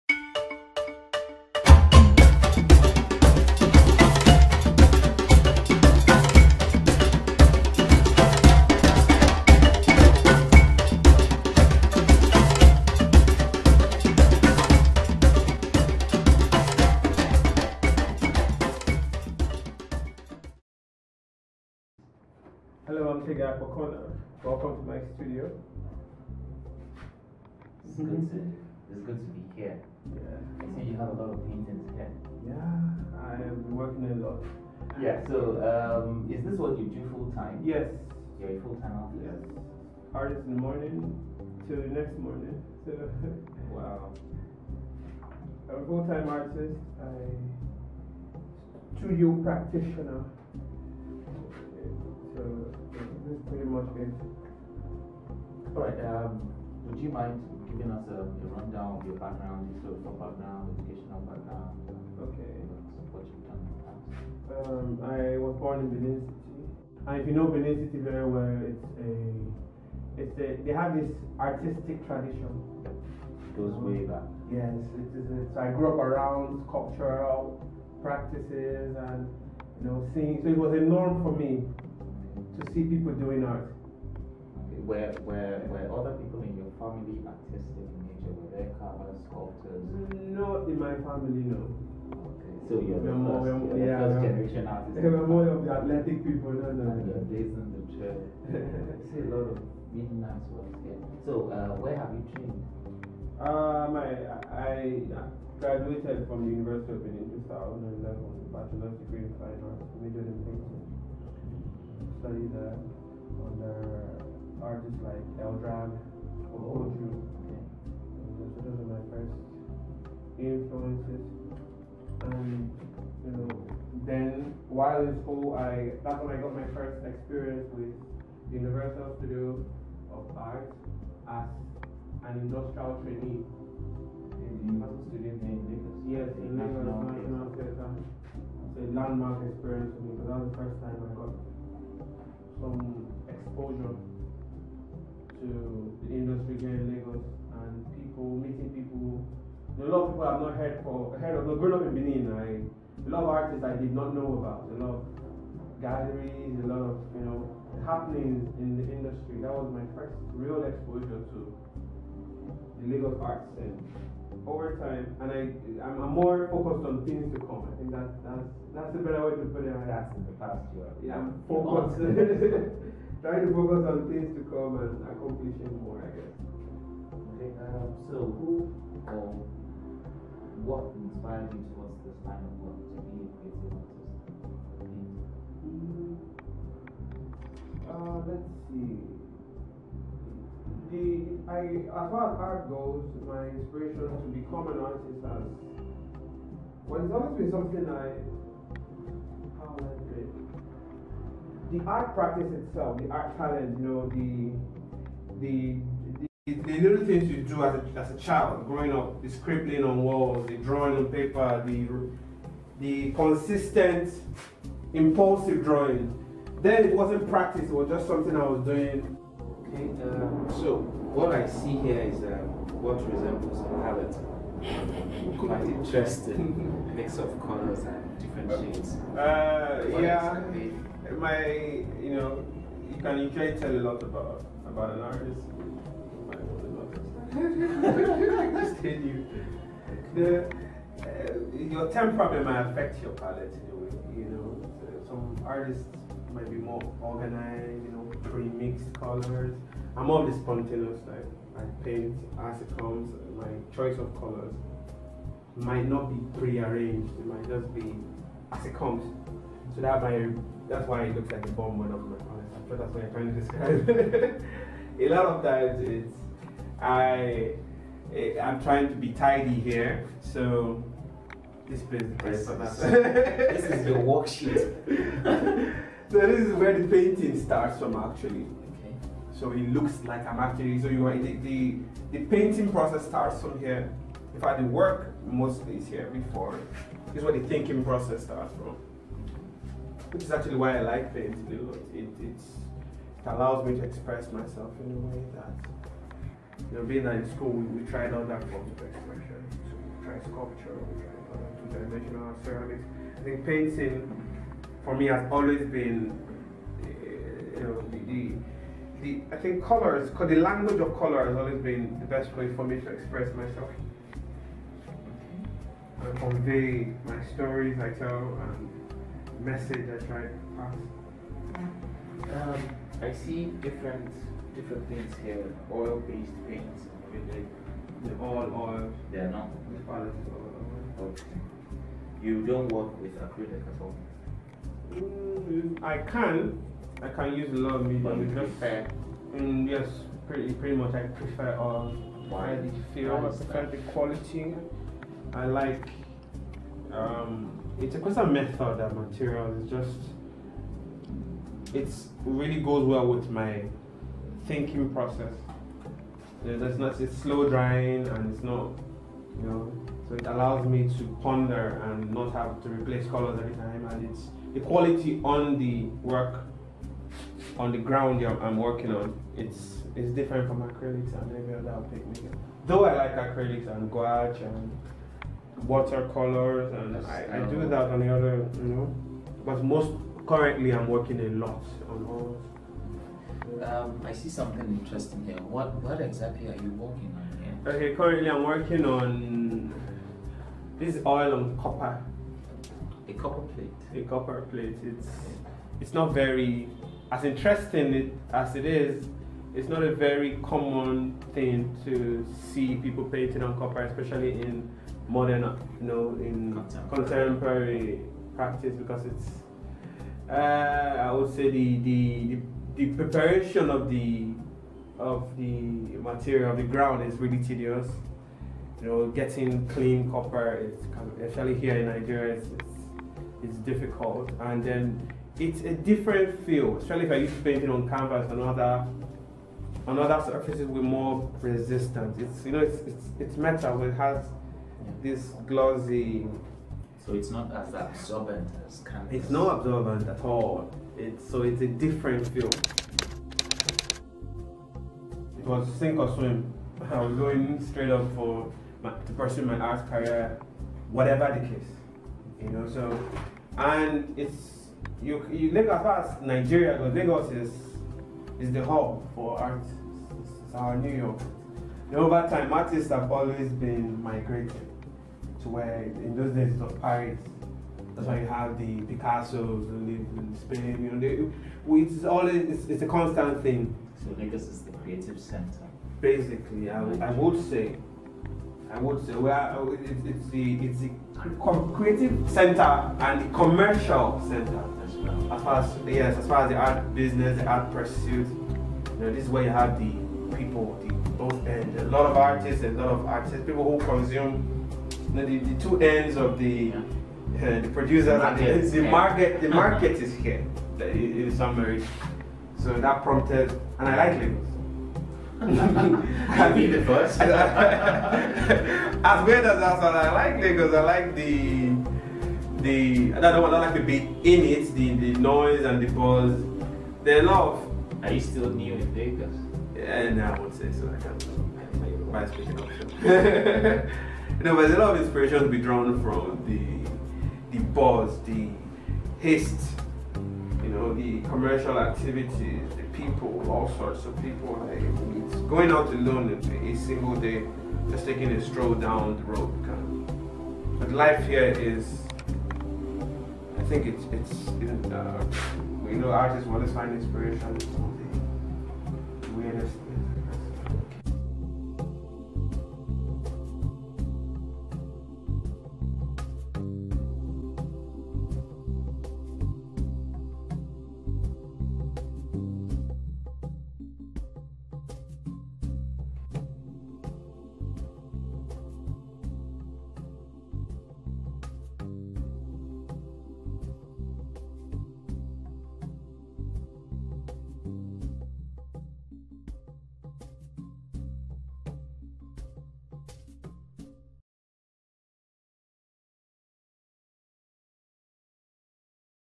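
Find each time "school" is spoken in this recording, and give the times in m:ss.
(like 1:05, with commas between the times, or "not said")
2:05, 4:57.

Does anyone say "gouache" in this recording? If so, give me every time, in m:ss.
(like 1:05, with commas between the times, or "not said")
6:13.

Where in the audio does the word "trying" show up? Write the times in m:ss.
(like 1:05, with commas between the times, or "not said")
2:53, 4:23, 4:28.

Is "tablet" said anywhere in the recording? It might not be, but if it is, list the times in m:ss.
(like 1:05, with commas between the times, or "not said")
not said.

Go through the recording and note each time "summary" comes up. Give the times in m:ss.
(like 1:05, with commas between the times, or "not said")
8:21.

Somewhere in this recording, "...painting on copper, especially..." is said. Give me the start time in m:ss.
6:43.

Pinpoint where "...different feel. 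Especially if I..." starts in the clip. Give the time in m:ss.
7:05.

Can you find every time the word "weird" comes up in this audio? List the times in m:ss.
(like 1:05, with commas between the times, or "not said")
8:29.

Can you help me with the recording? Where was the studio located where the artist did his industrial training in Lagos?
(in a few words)
National Theatre.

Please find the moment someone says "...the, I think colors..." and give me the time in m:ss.
5:09.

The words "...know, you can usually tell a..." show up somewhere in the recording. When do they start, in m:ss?
3:52.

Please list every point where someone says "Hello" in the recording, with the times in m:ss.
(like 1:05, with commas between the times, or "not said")
0:22.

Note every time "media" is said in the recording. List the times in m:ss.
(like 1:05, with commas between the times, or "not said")
5:37.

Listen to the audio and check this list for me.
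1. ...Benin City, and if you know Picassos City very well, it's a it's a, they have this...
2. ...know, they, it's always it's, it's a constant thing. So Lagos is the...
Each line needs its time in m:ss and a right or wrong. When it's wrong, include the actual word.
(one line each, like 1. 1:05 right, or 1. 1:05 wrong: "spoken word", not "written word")
1. 1:05 wrong: "Benin", not "Picassos"
2. 7:50 right.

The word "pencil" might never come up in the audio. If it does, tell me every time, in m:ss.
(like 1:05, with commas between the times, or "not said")
not said.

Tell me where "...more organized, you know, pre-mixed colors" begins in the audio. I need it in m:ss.
4:06.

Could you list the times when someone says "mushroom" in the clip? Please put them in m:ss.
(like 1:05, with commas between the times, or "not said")
not said.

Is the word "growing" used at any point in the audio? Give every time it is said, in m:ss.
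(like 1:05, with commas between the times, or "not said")
2:31, 3:28.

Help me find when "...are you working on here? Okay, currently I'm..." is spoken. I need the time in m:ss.
6:26.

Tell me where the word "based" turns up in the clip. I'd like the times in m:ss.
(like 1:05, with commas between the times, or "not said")
1:37, 5:25.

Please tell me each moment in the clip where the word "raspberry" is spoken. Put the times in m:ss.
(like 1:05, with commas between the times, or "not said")
not said.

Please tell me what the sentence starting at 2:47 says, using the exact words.
I think that, that's, that's a better way to put it.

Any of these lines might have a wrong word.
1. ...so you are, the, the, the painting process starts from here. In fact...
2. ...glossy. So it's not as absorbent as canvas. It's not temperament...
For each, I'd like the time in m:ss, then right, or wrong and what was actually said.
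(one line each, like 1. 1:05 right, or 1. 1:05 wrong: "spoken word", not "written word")
1. 4:40 right
2. 7:15 wrong: "absorbent", not "temperament".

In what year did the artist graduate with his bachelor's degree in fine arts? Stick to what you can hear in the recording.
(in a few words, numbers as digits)
2011.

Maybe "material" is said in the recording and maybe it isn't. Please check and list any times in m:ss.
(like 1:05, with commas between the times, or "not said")
5:48, 6:56.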